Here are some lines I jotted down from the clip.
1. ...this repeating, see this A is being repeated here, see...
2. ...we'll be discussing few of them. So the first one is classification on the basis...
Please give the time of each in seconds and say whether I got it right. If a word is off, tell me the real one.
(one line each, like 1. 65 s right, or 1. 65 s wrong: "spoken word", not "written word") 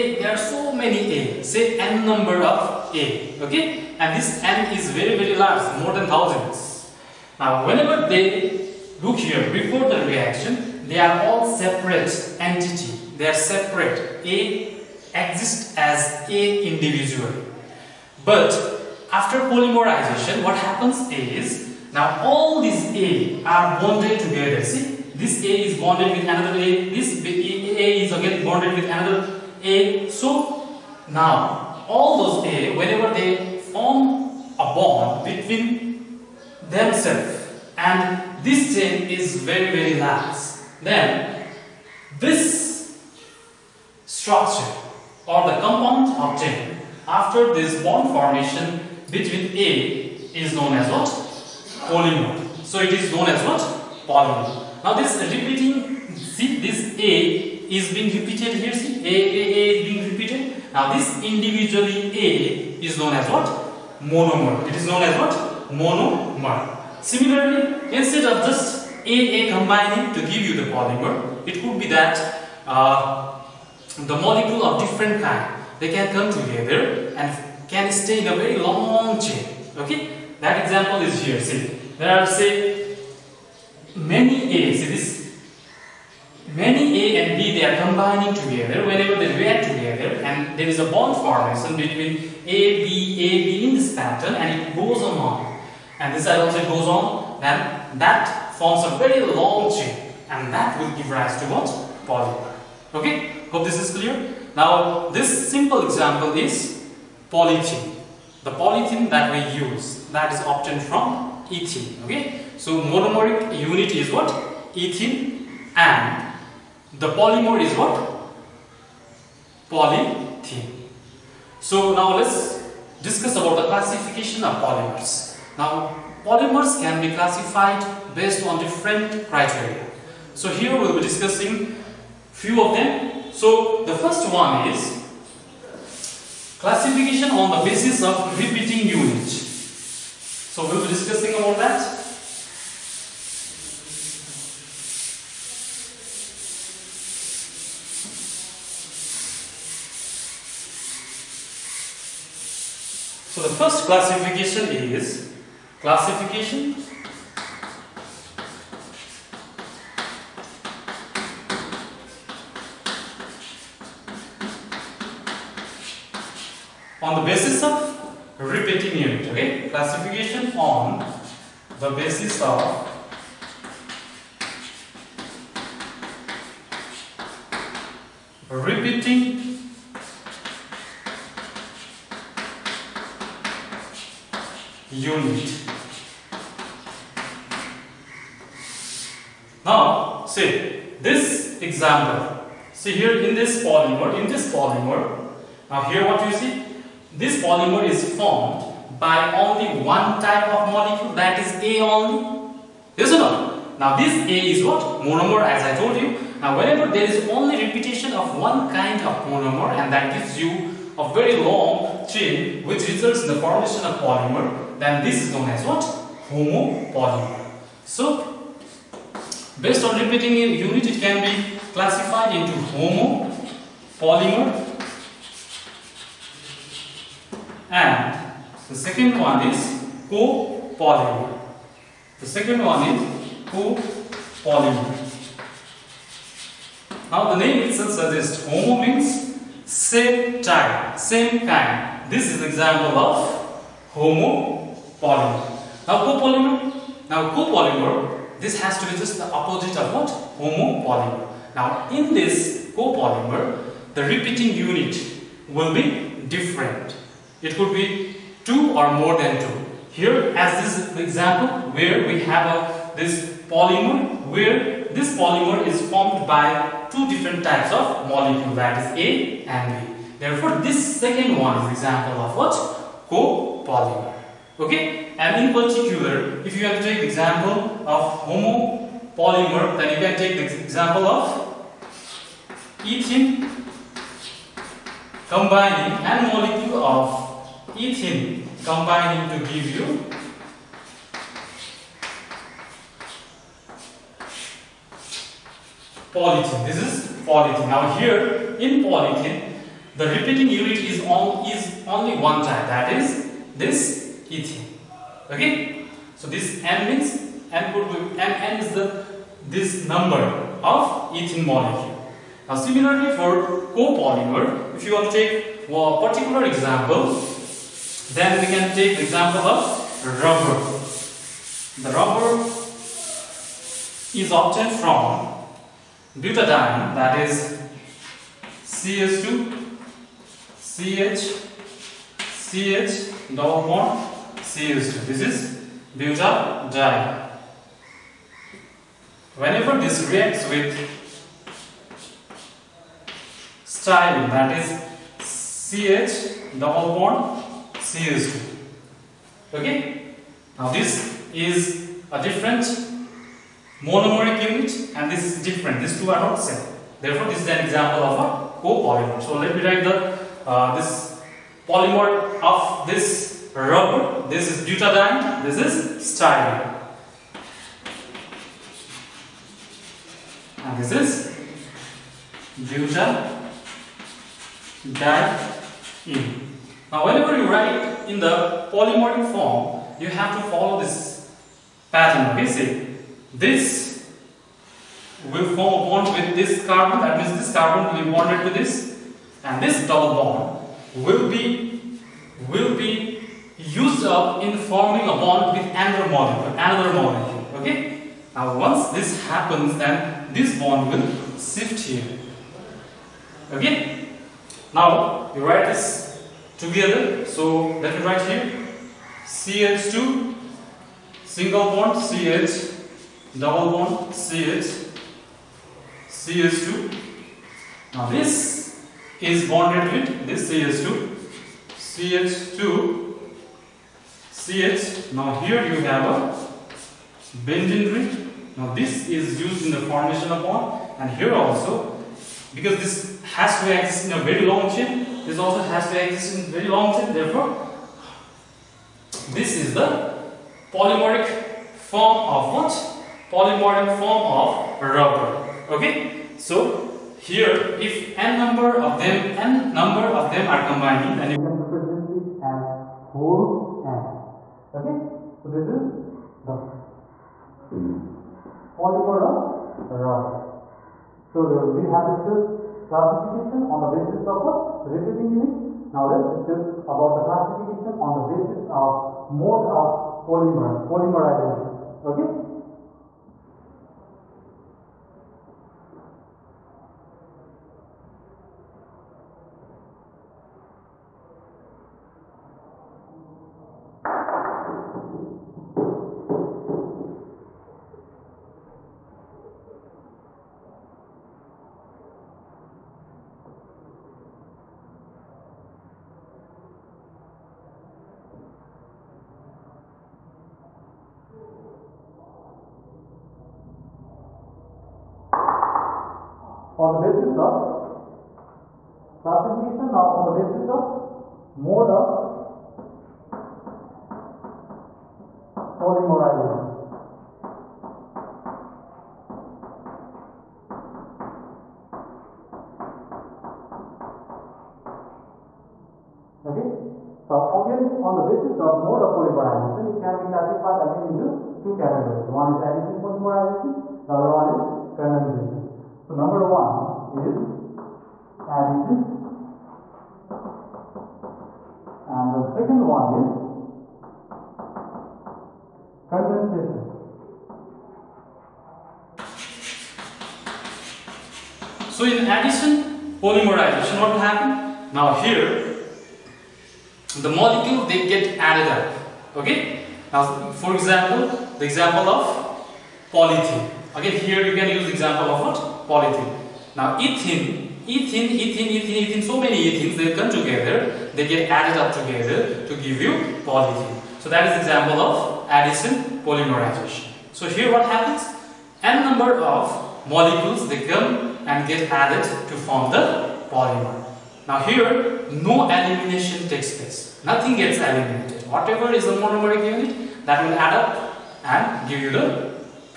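1. 54 s right
2. 130 s right.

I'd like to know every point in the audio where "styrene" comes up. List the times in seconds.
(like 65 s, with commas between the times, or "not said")
343 s, 366 s.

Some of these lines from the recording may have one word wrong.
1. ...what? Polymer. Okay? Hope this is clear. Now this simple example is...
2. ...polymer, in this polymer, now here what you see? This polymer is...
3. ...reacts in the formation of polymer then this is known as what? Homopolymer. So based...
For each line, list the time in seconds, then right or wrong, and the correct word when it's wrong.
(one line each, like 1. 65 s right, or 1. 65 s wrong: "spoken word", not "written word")
1. 101 s right
2. 193 s right
3. 212 s wrong: "results", not "reacts".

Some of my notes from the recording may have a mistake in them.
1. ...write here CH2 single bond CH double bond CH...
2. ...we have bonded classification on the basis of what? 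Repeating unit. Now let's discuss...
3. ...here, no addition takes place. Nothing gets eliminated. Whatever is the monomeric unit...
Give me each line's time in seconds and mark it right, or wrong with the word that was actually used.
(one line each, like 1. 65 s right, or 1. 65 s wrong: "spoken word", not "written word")
1. 408 s right
2. 461 s wrong: "discussed", not "bonded"
3. 584 s wrong: "elimination", not "addition".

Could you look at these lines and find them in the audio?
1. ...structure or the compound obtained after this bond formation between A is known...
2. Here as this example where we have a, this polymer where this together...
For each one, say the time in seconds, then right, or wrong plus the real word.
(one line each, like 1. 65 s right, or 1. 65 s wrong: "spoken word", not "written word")
1. 44 s right
2. 259 s wrong: "polymer", not "together".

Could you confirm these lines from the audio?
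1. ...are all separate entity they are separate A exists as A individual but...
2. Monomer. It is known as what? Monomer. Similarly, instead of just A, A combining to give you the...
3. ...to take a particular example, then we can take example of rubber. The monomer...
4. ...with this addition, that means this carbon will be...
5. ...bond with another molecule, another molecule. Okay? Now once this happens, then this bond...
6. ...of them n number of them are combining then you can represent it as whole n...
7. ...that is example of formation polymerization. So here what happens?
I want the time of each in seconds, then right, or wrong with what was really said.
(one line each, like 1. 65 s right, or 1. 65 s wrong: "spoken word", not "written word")
1. 11 s right
2. 64 s right
3. 315 s wrong: "rubber", not "monomer"
4. 386 s wrong: "carbon", not "addition"
5. 395 s right
6. 448 s right
7. 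574 s wrong: "addition", not "formation".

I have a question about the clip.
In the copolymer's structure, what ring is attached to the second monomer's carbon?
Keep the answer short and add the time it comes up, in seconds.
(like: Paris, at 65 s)
benzene ring, at 427 s.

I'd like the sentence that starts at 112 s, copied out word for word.
Okay, so monomeric unit is what ethene, and the polymer is what polythene.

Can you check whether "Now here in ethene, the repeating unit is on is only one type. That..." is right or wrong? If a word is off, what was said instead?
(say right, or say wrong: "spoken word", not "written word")
wrong: "polythene", not "ethene".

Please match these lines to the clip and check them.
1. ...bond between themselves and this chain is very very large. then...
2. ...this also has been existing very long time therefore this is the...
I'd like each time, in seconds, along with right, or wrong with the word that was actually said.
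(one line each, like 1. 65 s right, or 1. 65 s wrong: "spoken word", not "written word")
1. 34 s right
2. 435 s right.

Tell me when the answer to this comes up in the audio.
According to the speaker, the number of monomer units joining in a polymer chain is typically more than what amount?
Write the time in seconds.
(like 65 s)
5 s.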